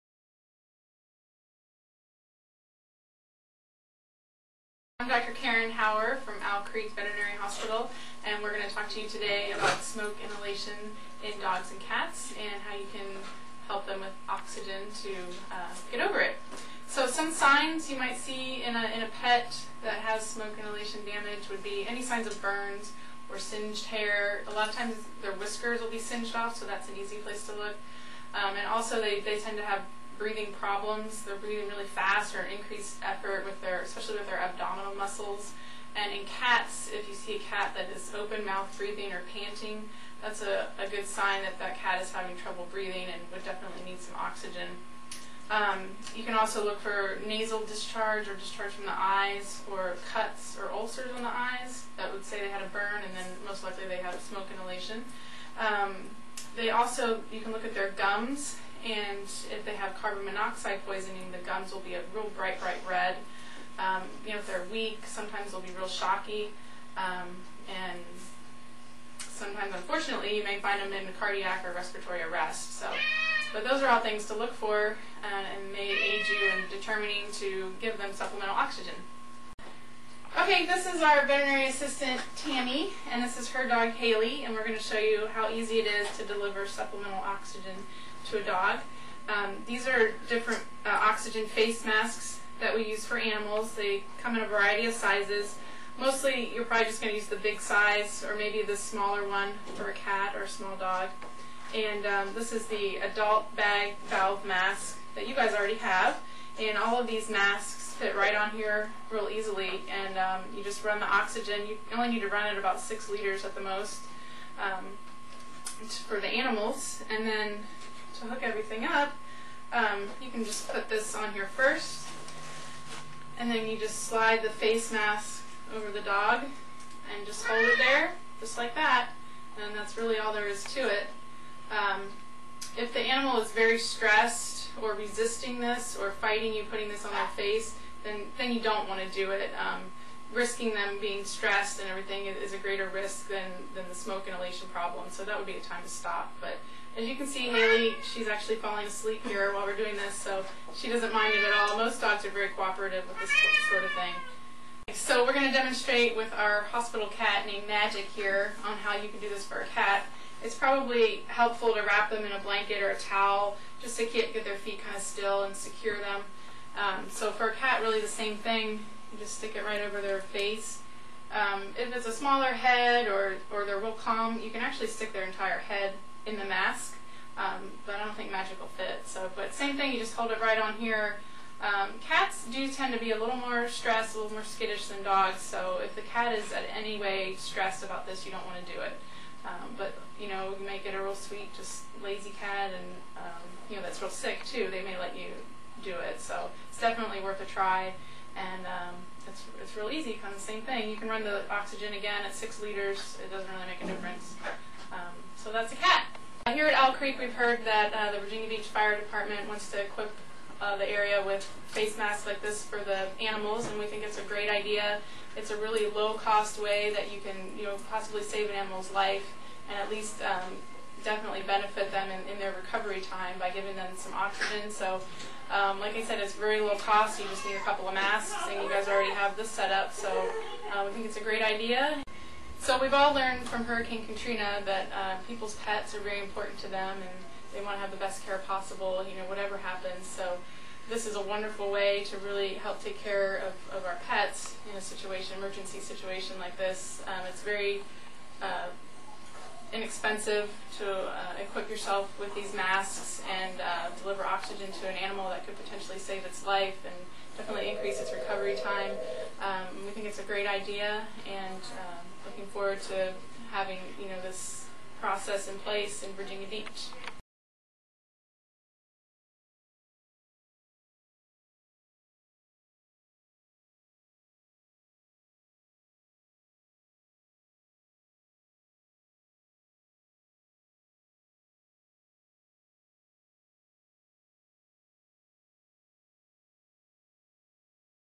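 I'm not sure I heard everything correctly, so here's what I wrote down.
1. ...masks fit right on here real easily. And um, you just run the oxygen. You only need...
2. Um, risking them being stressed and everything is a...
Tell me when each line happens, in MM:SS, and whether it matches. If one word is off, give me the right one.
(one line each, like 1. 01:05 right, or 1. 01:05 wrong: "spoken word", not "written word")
1. 01:47 right
2. 02:19 right.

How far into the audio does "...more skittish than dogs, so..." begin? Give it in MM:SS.
03:04.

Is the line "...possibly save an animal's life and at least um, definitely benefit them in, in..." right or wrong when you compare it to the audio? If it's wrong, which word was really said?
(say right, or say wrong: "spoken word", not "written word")
right.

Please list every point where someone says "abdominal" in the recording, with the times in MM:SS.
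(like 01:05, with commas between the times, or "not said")
00:34.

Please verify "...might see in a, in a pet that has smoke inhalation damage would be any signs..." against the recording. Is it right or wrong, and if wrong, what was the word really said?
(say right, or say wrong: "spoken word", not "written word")
right.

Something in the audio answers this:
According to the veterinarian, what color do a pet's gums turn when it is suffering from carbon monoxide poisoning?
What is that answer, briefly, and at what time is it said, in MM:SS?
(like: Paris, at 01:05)
bright red, at 01:02.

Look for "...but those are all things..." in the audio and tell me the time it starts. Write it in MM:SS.
01:13.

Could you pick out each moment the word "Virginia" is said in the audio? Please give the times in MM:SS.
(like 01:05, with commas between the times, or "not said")
03:28, 04:26.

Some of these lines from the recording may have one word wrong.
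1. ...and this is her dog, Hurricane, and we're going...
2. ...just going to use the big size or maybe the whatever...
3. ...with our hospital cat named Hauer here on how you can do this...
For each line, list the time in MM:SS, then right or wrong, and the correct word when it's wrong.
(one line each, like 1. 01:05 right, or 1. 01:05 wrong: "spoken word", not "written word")
1. 01:23 wrong: "Haley", not "Hurricane"
2. 01:36 wrong: "smaller", not "whatever"
3. 02:36 wrong: "Magic", not "Hauer".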